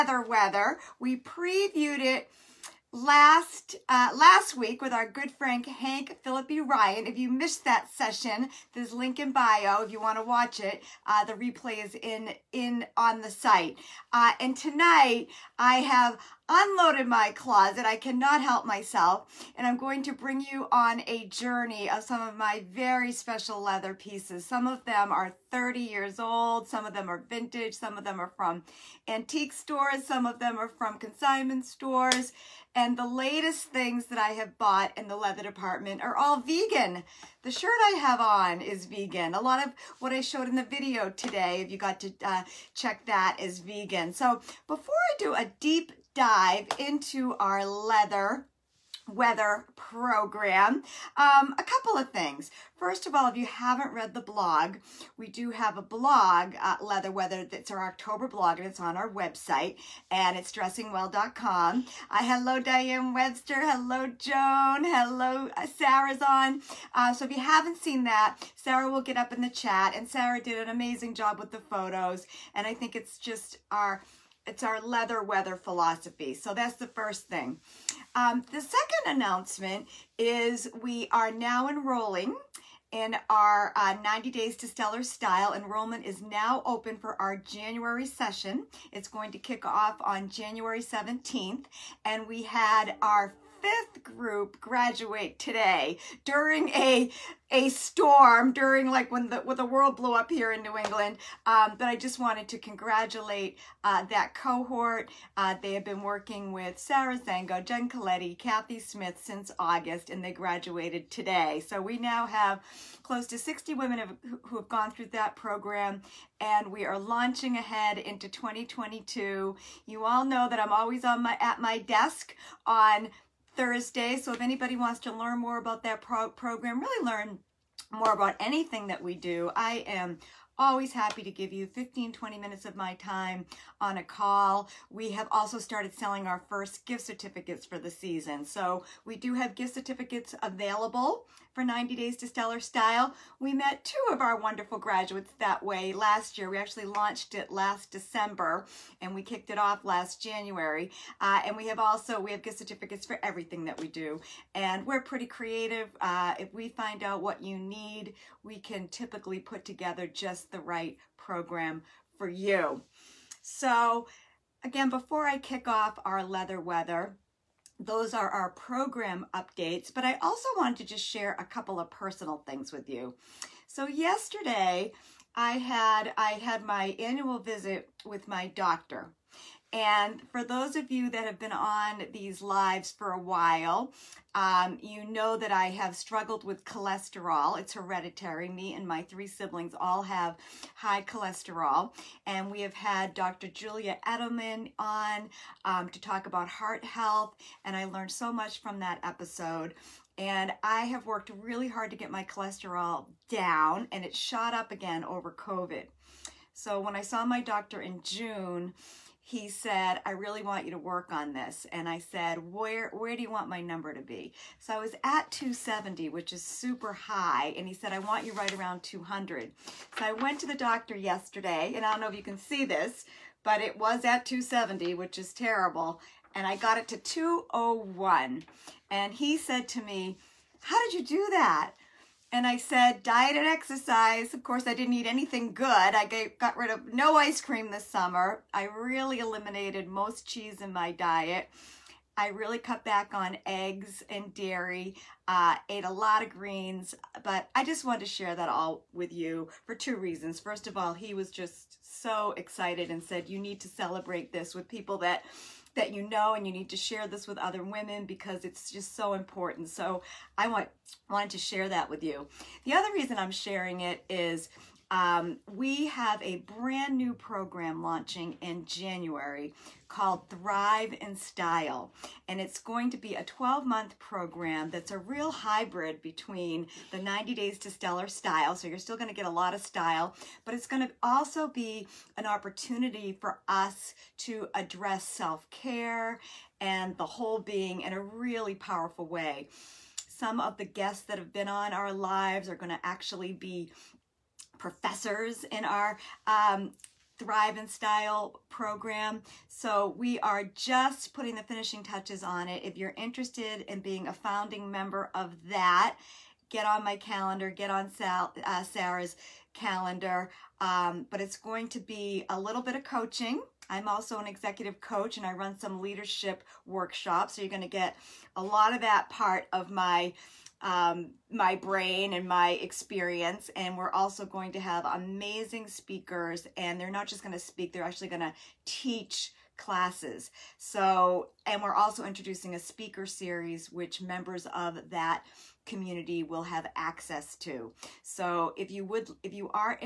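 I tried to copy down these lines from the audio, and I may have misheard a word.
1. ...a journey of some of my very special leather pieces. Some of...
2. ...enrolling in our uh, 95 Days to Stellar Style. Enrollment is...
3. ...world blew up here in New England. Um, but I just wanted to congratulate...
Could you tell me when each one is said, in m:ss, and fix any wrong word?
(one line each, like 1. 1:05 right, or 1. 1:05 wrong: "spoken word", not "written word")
1. 0:21 right
2. 1:21 wrong: "90", not "95"
3. 1:39 right.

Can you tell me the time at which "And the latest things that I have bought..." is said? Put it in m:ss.
0:32.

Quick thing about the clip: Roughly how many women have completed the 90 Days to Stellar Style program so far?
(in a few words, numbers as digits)
close to 60.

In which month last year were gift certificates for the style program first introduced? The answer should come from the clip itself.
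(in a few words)
December.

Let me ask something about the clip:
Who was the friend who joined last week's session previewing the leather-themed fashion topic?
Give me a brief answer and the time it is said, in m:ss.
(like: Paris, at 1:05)
Hank Phillippi Ryan, at 0:05.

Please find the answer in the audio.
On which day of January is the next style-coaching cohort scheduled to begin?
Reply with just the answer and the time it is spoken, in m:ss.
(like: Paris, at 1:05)
17th, at 1:30.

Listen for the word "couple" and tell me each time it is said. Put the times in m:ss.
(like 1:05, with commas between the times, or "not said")
0:51, 2:51.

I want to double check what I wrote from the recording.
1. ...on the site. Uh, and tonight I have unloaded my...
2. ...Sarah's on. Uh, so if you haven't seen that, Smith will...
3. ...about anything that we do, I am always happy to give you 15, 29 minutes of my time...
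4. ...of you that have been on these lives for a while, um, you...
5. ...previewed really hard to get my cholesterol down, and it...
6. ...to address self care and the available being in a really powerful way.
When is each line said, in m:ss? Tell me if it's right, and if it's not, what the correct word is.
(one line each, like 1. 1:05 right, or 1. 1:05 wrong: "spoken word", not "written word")
1. 0:12 right
2. 1:05 wrong: "Sarah", not "Smith"
3. 2:08 wrong: "20", not "29"
4. 3:00 right
5. 3:21 wrong: "worked", not "previewed"
6. 4:44 wrong: "whole", not "available".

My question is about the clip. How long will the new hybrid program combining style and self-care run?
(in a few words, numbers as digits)
12 months.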